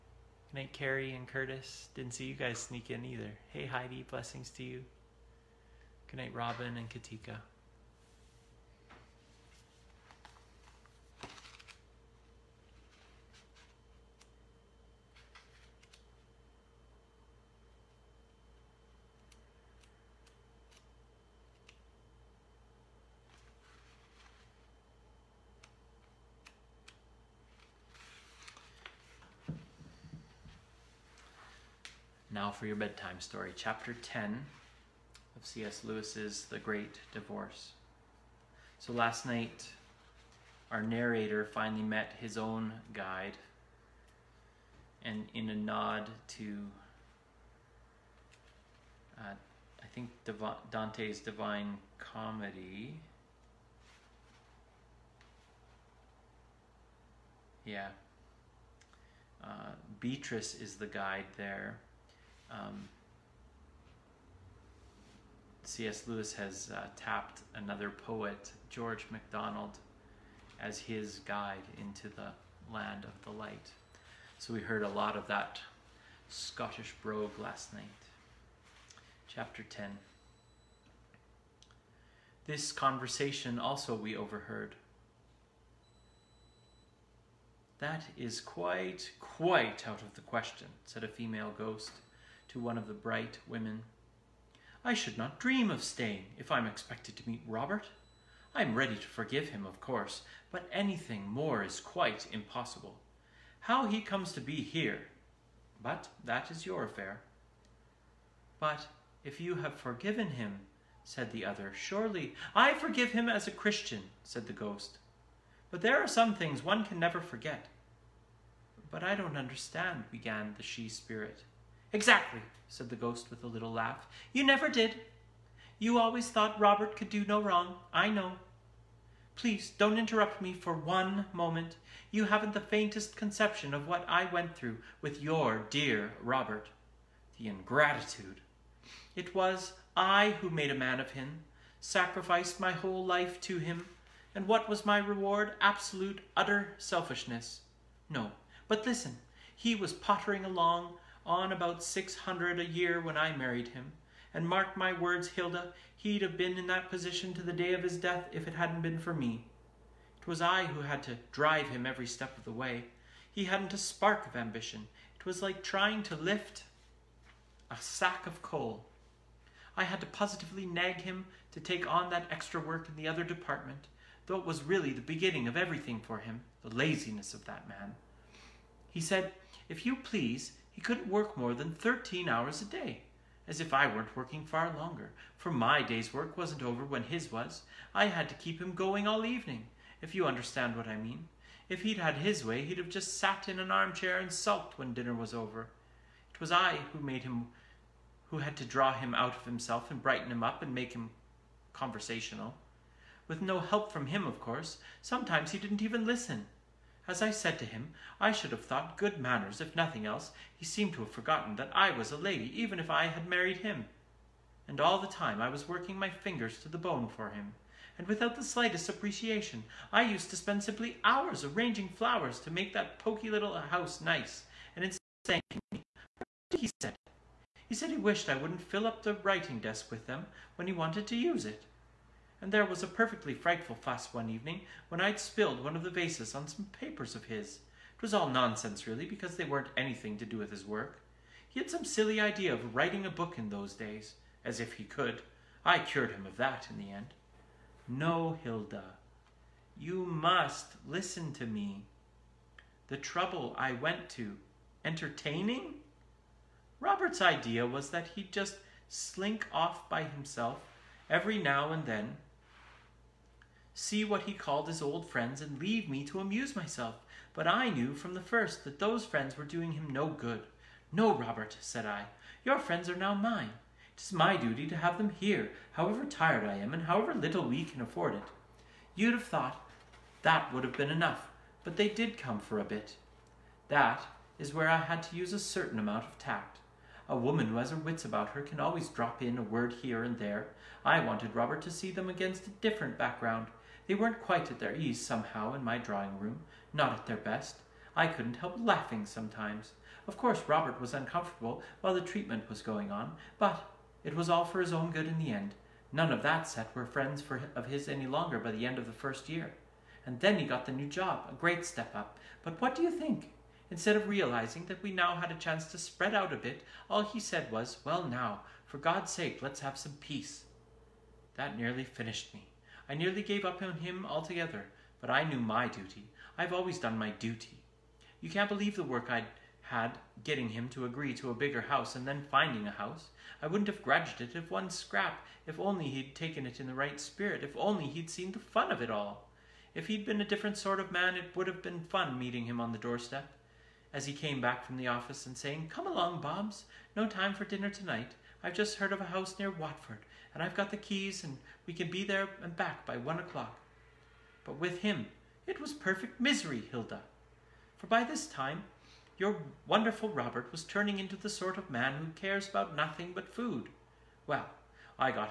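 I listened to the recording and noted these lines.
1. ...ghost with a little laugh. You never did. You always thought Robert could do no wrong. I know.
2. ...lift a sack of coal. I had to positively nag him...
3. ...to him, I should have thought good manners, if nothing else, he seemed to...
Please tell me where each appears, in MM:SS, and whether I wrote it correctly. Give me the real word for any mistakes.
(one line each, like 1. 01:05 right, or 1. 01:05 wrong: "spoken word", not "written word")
1. 02:02 right
2. 02:46 right
3. 03:27 right.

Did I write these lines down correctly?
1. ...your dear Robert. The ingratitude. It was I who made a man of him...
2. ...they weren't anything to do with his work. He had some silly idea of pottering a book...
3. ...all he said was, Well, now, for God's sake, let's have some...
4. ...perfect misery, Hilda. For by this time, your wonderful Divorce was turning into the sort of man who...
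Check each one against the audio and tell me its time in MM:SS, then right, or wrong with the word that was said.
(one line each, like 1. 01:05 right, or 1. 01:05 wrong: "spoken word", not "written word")
1. 02:15 right
2. 03:59 wrong: "writing", not "pottering"
3. 05:16 right
4. 05:55 wrong: "Robert", not "Divorce".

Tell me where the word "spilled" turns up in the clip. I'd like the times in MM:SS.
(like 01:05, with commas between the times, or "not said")
03:55.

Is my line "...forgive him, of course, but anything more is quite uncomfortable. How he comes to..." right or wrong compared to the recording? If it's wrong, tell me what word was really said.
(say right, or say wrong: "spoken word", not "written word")
wrong: "impossible", not "uncomfortable".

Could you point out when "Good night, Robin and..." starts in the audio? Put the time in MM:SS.
00:06.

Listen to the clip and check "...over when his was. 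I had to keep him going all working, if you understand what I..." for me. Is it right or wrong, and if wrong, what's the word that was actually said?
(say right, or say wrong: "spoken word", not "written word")
wrong: "evening", not "working".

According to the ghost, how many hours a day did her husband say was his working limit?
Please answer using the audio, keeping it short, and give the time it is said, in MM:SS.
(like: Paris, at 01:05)
13, at 03:01.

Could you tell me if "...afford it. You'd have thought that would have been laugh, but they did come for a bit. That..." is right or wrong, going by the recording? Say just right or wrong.
wrong.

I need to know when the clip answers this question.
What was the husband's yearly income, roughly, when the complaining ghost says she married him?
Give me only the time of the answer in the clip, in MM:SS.
02:31.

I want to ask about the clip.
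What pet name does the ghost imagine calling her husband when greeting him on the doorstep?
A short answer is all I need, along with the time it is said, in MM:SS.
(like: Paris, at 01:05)
Bobs, at 05:46.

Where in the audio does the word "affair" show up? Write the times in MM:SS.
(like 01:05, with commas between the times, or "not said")
01:46.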